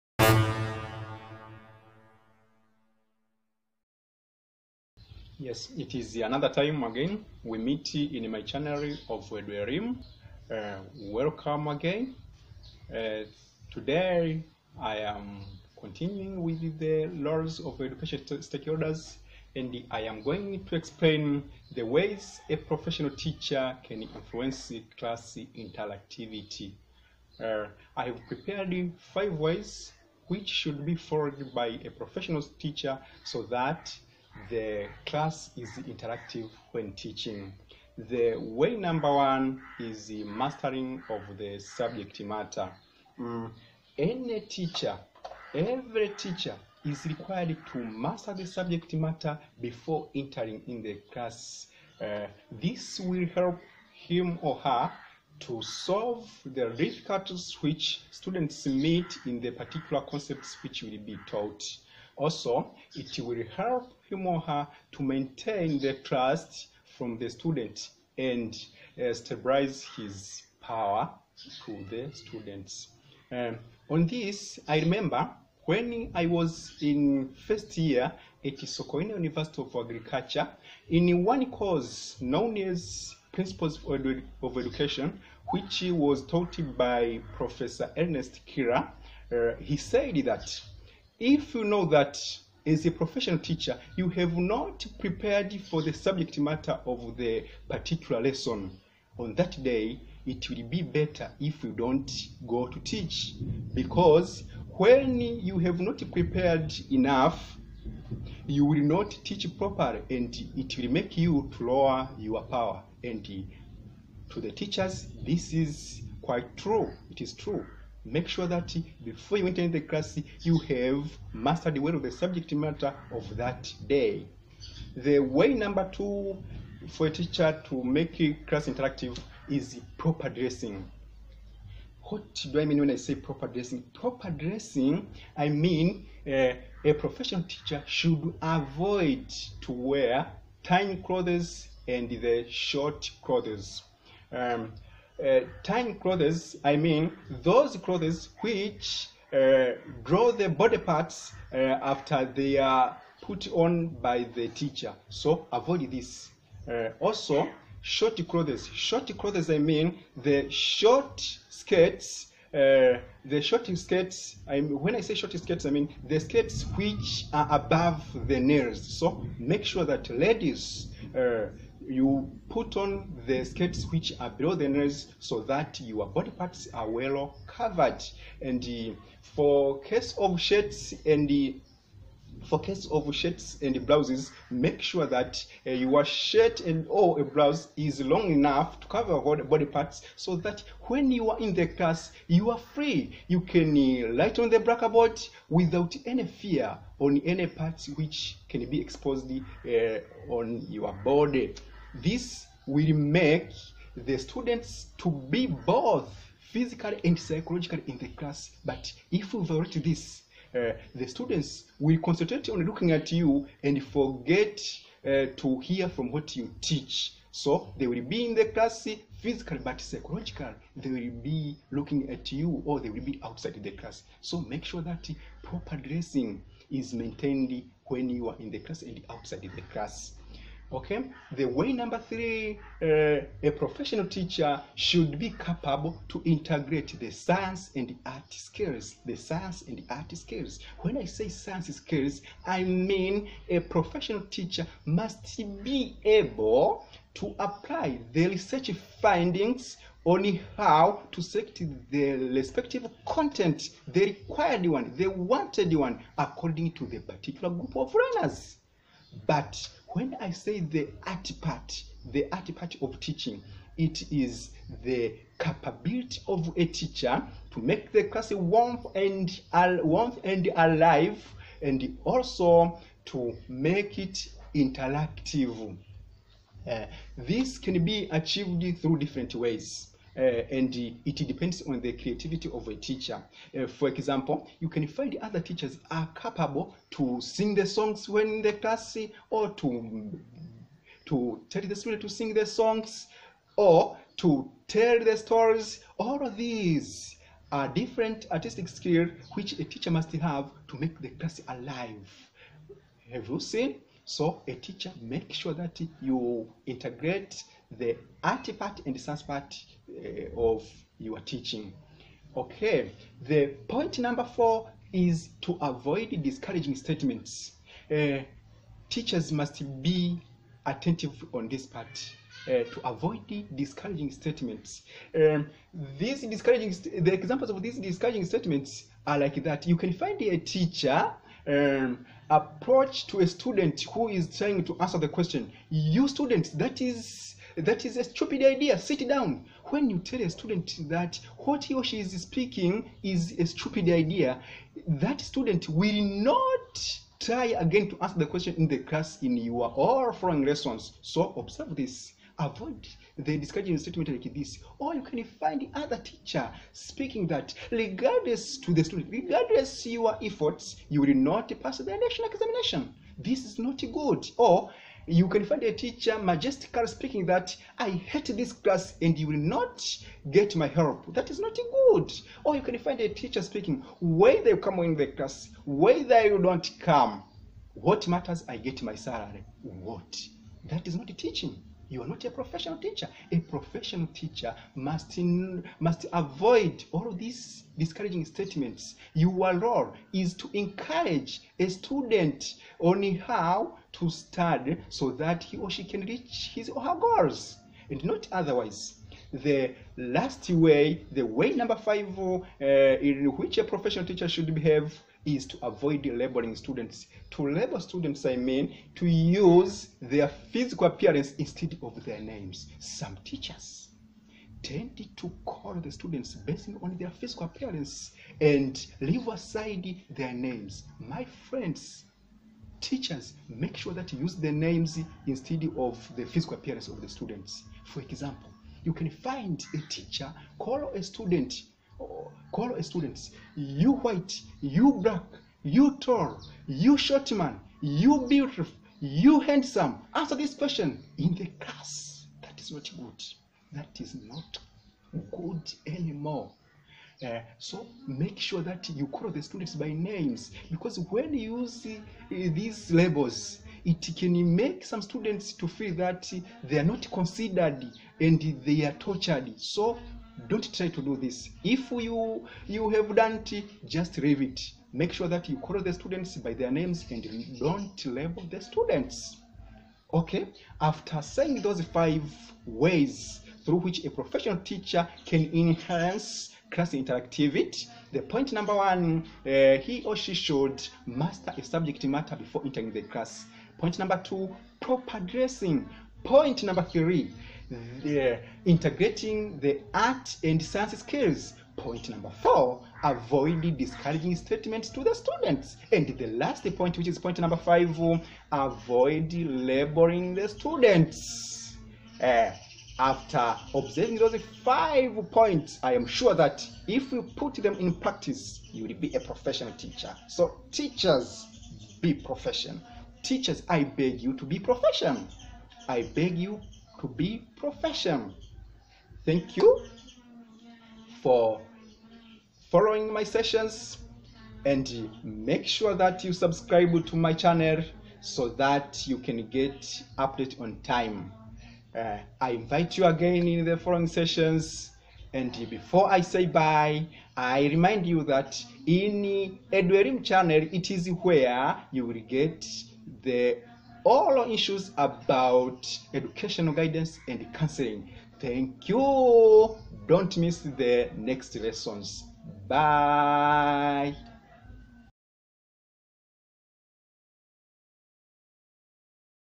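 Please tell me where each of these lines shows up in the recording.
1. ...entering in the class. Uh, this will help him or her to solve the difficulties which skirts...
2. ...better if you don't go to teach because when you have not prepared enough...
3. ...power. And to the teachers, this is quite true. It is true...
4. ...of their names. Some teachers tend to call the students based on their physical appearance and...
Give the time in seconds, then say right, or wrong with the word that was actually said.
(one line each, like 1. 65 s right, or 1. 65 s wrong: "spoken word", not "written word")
1. 50 s wrong: "students", not "skirts"
2. 100 s right
3. 112 s right
4. 411 s right.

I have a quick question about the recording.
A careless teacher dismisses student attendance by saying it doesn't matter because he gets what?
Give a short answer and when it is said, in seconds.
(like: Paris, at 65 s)
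My salary, at 378 s.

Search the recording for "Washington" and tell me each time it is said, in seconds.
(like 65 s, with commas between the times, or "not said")
not said.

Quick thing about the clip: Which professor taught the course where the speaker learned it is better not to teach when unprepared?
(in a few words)
Ernest Kira.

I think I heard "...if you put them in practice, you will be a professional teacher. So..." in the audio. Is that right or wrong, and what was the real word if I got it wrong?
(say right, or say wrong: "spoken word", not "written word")
right.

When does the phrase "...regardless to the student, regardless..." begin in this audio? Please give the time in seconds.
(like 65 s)
357 s.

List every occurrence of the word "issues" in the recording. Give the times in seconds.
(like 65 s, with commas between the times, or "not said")
544 s.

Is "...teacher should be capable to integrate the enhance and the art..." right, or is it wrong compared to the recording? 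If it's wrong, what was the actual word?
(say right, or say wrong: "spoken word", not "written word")
wrong: "science", not "enhance".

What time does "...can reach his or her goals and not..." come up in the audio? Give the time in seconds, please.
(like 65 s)
395 s.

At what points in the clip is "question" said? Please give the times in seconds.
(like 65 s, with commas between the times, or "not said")
335 s, 348 s, 440 s.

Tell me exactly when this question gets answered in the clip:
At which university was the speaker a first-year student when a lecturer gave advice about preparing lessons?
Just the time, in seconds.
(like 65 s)
78 s.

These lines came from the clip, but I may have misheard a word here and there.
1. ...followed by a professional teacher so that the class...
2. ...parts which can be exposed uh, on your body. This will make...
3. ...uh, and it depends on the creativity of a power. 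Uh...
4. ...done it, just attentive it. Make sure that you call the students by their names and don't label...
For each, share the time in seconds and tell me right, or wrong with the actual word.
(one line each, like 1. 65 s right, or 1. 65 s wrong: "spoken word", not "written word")
1. 30 s right
2. 197 s right
3. 280 s wrong: "teacher", not "power"
4. 463 s wrong: "leave", not "attentive".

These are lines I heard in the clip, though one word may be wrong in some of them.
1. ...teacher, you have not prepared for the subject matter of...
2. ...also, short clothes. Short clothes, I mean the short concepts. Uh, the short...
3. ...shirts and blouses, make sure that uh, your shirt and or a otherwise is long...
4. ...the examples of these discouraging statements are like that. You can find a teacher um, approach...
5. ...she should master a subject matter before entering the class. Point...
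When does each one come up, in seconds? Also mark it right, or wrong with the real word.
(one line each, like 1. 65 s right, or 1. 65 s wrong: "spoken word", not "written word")
1. 93 s right
2. 156 s wrong: "skirts", not "concepts"
3. 183 s wrong: "blouse", not "otherwise"
4. 327 s right
5. 480 s right.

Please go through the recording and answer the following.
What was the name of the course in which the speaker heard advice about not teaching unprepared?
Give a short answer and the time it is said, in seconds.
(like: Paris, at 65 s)
Principles of Education, at 83 s.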